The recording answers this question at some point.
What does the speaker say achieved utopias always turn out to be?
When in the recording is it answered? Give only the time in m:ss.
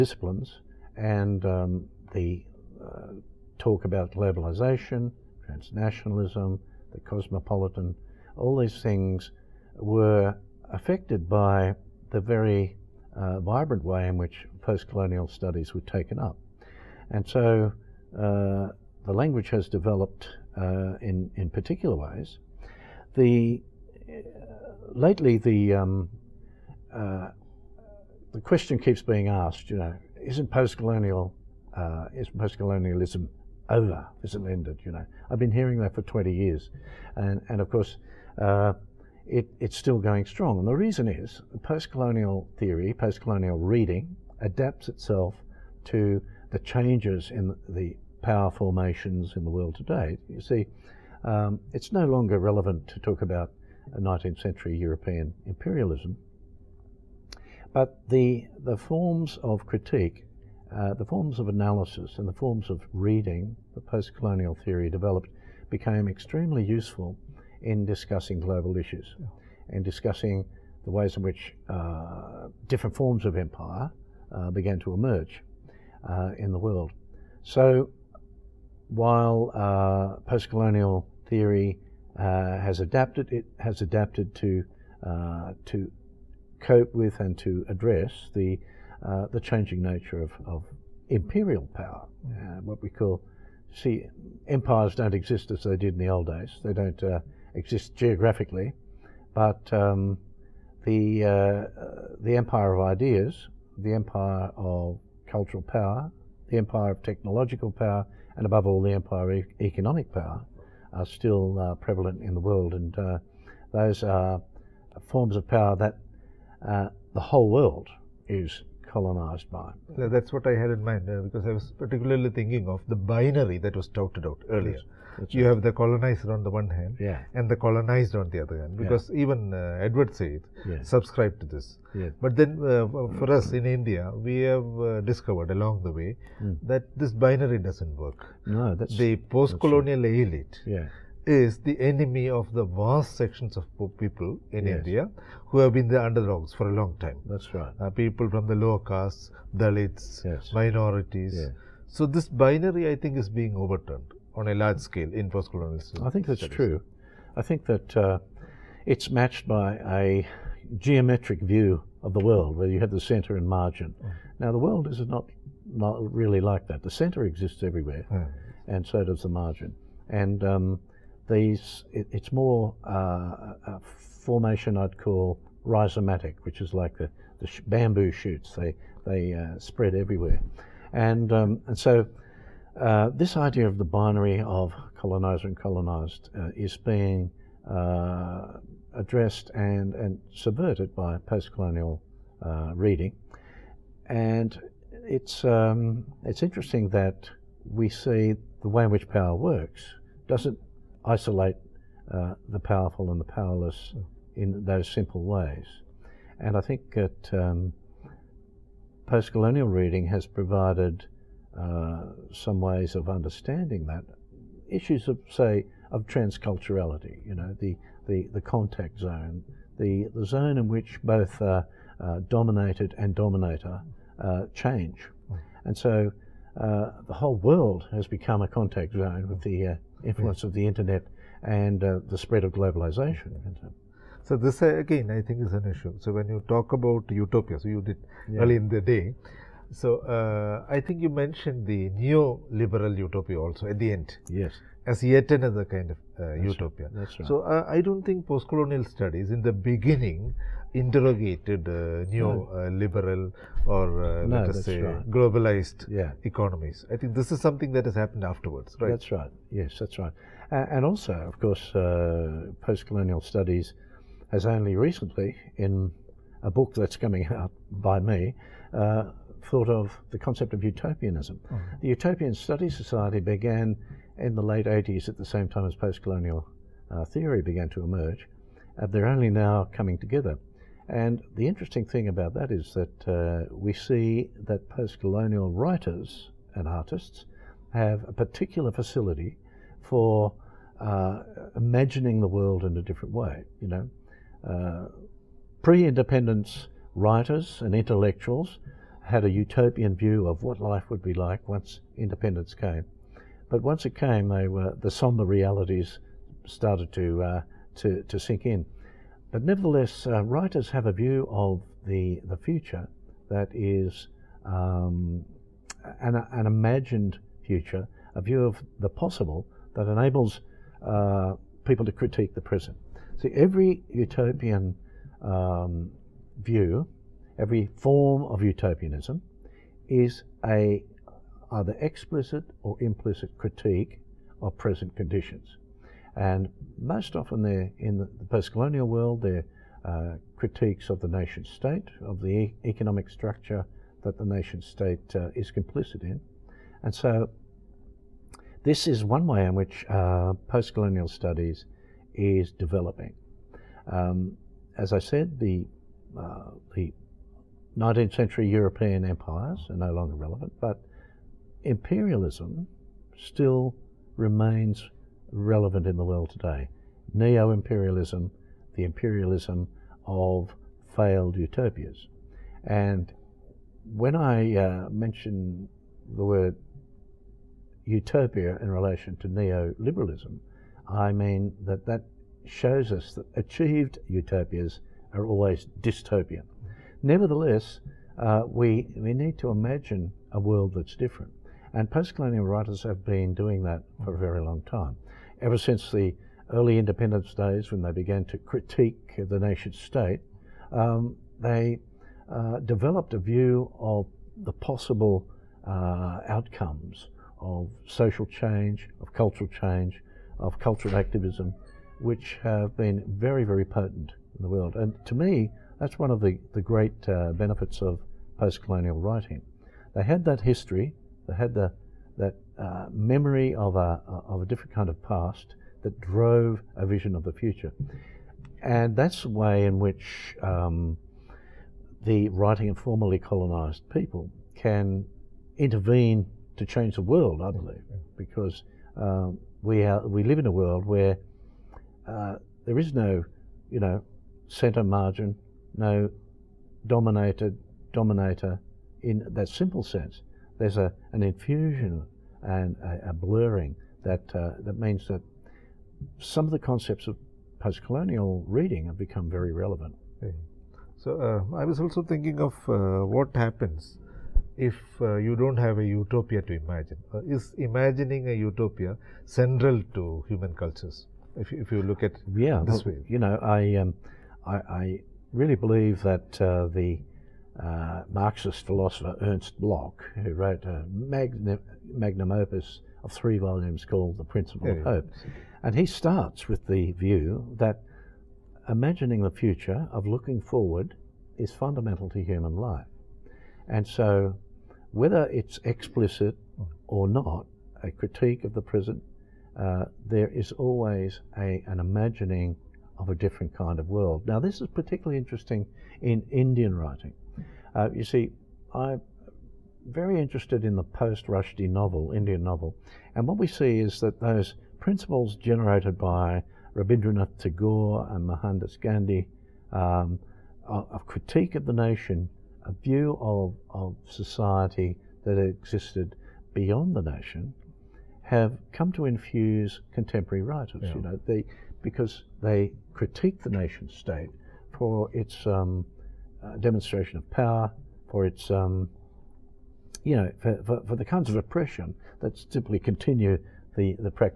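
6:25.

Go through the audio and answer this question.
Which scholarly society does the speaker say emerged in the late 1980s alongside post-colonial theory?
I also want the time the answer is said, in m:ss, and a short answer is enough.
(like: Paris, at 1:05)
The Utopian Studies Society, at 4:31.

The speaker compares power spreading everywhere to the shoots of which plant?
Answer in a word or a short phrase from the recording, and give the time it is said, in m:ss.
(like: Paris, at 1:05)
Bamboo, at 2:57.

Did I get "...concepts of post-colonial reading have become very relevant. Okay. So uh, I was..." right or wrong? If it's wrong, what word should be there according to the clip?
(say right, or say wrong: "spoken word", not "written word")
right.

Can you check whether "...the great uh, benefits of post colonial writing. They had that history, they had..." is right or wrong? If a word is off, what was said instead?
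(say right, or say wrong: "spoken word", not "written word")
right.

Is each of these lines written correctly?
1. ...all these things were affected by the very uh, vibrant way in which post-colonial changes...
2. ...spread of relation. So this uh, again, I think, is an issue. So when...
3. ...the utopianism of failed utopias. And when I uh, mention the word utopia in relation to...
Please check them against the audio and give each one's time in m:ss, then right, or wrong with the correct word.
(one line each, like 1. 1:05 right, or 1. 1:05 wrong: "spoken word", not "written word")
1. 0:08 wrong: "studies", not "changes"
2. 3:52 wrong: "globalization", not "relation"
3. 6:08 wrong: "imperialism", not "utopianism".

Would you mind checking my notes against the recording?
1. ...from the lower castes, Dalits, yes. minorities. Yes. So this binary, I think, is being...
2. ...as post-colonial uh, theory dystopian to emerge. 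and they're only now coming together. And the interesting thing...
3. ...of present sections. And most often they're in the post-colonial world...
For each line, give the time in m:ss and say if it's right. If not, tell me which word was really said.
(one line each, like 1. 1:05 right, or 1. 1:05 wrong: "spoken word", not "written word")
1. 2:28 right
2. 4:35 wrong: "began", not "dystopian"
3. 5:34 wrong: "conditions", not "sections".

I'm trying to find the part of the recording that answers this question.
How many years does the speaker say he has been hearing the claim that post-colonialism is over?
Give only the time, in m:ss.
0:36.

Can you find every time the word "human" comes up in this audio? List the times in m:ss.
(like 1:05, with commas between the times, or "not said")
7:50, 8:12.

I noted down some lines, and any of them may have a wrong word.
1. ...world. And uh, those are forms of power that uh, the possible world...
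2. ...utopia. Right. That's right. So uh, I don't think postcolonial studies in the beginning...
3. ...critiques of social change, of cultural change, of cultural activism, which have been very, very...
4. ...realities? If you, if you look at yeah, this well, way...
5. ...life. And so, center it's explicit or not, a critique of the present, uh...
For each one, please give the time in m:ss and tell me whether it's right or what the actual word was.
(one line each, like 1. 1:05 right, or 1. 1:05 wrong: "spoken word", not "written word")
1. 1:52 wrong: "whole", not "possible"
2. 4:06 right
3. 6:46 wrong: "outcomes", not "critiques"
4. 7:50 wrong: "cultures", not "realities"
5. 8:12 wrong: "whether", not "center".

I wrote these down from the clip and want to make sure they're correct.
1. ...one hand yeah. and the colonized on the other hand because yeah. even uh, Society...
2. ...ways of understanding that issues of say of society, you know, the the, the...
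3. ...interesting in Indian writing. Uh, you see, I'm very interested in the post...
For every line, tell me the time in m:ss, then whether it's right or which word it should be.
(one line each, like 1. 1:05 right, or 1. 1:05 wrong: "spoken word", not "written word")
1. 2:06 wrong: "Edward", not "Society"
2. 3:32 wrong: "transculturality", not "society"
3. 8:25 right.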